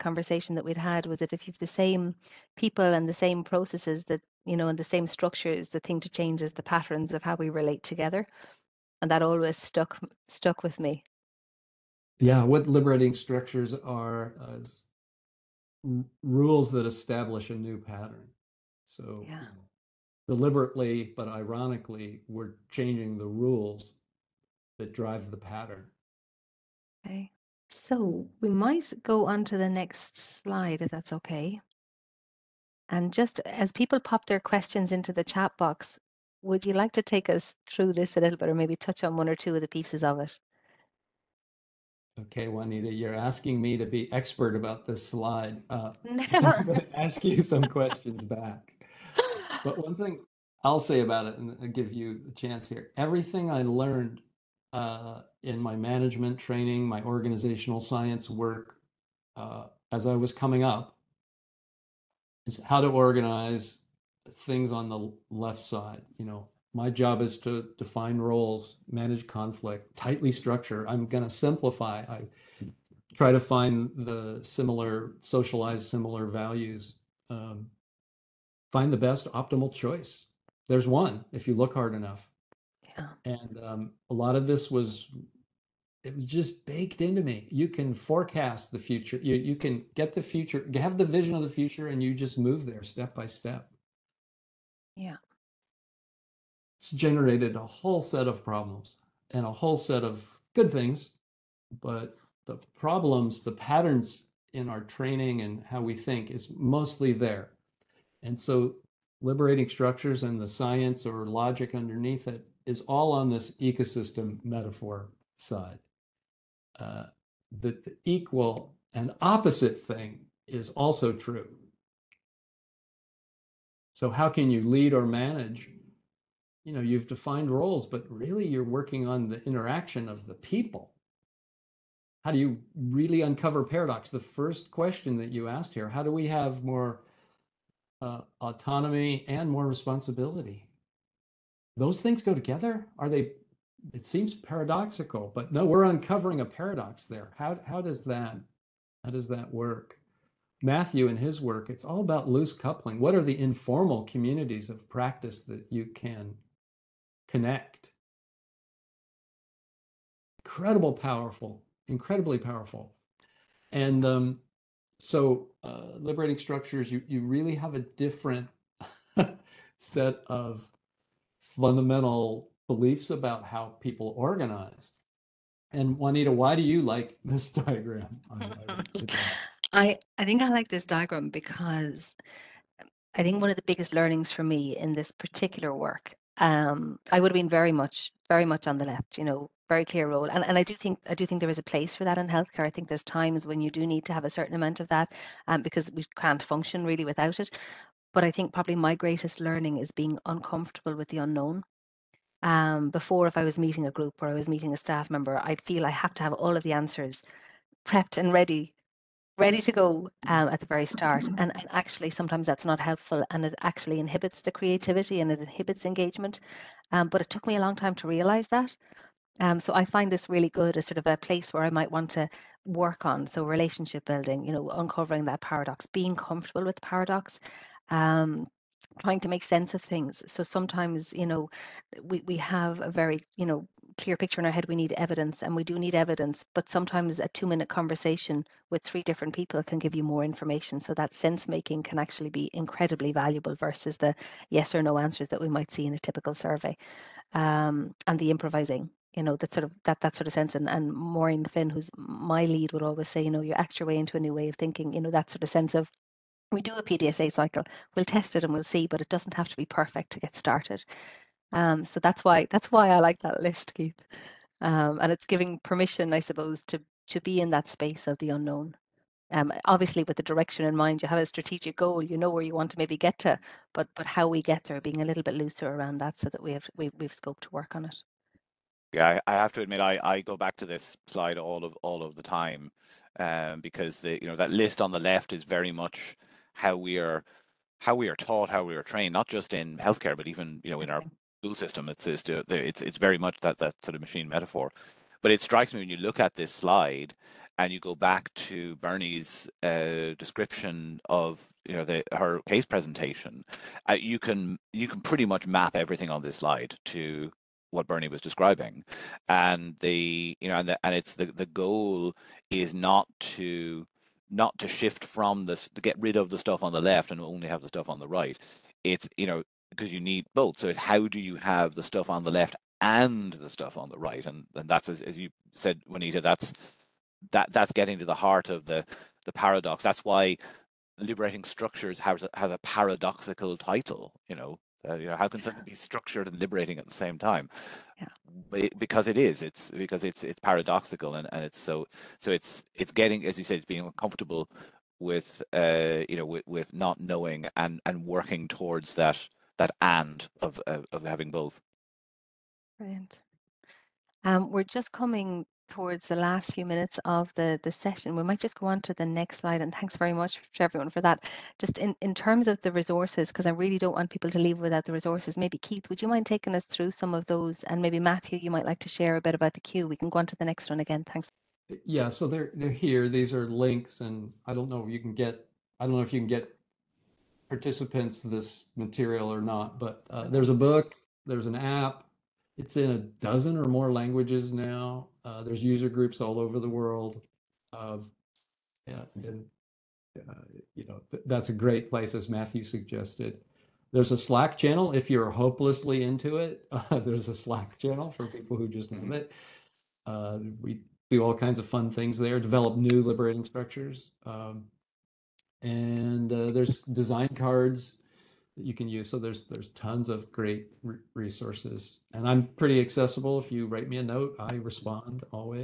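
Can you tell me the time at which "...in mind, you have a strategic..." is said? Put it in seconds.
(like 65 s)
270 s.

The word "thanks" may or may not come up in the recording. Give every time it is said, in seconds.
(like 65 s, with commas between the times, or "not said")
359 s, 371 s.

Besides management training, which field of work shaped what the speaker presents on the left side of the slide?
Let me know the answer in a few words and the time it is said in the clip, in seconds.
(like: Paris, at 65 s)
organizational science, at 57 s.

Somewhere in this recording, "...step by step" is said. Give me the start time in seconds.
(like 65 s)
92 s.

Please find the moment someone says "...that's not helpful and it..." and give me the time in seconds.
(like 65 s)
212 s.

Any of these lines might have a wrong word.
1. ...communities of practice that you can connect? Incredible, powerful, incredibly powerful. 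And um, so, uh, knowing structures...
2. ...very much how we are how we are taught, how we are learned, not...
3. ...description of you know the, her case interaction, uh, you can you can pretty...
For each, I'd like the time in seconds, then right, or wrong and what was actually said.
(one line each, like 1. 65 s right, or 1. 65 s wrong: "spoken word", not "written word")
1. 154 s wrong: "liberating", not "knowing"
2. 285 s wrong: "trained", not "learned"
3. 300 s wrong: "presentation", not "interaction".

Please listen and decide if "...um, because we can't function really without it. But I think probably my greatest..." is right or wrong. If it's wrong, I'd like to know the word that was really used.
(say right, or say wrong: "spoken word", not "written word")
right.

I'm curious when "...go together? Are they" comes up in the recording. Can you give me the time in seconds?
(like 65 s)
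142 s.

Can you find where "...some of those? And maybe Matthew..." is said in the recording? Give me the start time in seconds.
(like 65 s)
366 s.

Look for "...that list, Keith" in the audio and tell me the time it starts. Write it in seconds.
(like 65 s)
263 s.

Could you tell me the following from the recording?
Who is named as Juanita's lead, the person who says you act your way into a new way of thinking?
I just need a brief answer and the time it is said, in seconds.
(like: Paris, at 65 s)
Maureen Finn, at 250 s.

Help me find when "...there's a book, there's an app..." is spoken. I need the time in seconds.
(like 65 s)
380 s.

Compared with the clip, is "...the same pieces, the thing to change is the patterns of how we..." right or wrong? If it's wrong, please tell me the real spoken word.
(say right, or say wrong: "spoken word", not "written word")
wrong: "structures", not "pieces".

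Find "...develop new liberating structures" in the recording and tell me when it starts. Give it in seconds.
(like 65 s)
402 s.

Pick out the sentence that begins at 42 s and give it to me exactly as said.
Okay, Juanita, you're asking me to be expert about this slide.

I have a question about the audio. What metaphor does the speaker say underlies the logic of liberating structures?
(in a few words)
ecosystem metaphor.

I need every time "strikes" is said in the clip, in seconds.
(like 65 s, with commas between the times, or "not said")
295 s.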